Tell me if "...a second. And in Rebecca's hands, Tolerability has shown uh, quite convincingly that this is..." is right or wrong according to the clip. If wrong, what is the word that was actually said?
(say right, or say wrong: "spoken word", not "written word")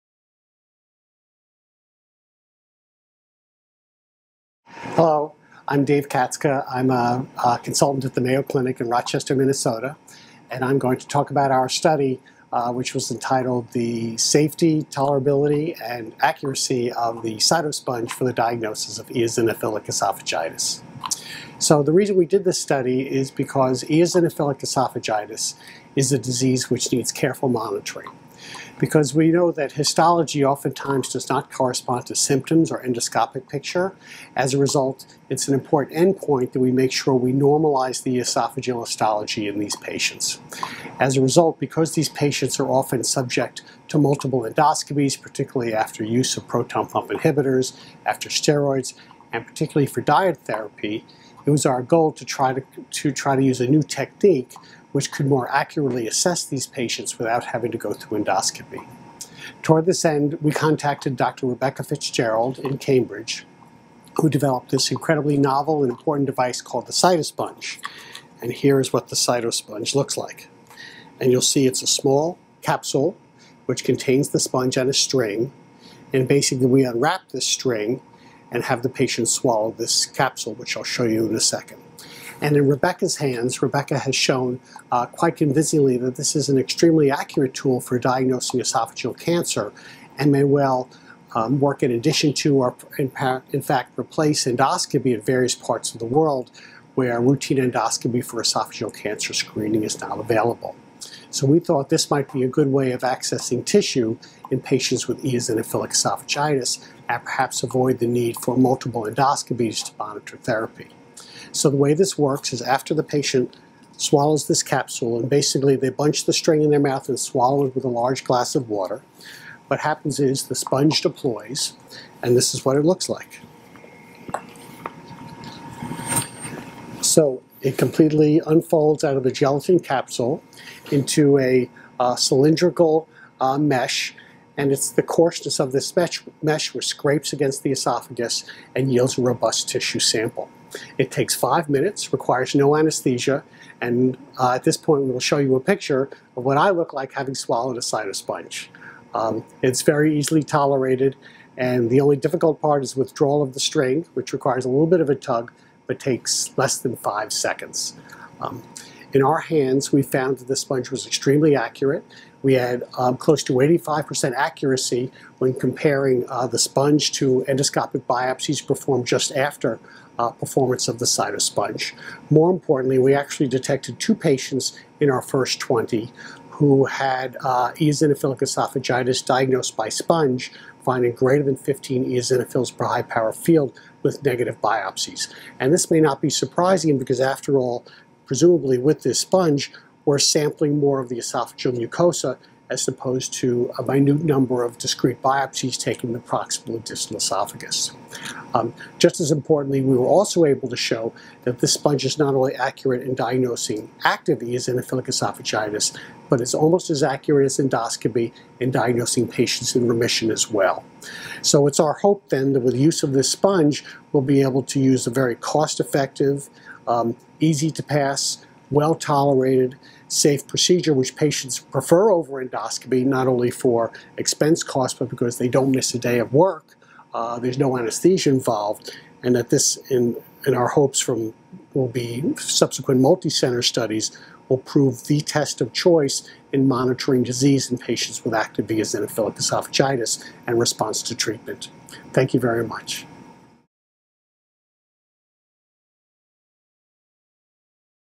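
wrong: "Rebecca", not "Tolerability".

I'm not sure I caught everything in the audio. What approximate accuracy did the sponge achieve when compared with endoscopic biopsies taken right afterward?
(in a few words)
85%.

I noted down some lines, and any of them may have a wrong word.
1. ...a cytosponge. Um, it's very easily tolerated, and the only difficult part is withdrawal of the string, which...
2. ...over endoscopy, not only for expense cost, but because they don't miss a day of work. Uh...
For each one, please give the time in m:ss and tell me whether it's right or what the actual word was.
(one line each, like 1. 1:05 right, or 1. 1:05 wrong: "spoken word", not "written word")
1. 2:27 right
2. 3:42 right.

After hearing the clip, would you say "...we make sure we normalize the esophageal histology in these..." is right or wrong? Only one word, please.
right.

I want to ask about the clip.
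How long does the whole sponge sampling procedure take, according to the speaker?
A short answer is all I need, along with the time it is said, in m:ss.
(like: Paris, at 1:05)
5 minutes, at 2:21.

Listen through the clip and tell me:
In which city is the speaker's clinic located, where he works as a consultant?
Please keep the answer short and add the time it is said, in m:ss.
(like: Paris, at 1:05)
Rochester, Minnesota, at 0:08.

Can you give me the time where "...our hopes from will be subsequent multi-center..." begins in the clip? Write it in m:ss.
3:50.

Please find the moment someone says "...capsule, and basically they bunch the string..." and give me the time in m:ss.
1:54.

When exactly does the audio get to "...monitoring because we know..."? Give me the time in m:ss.
0:27.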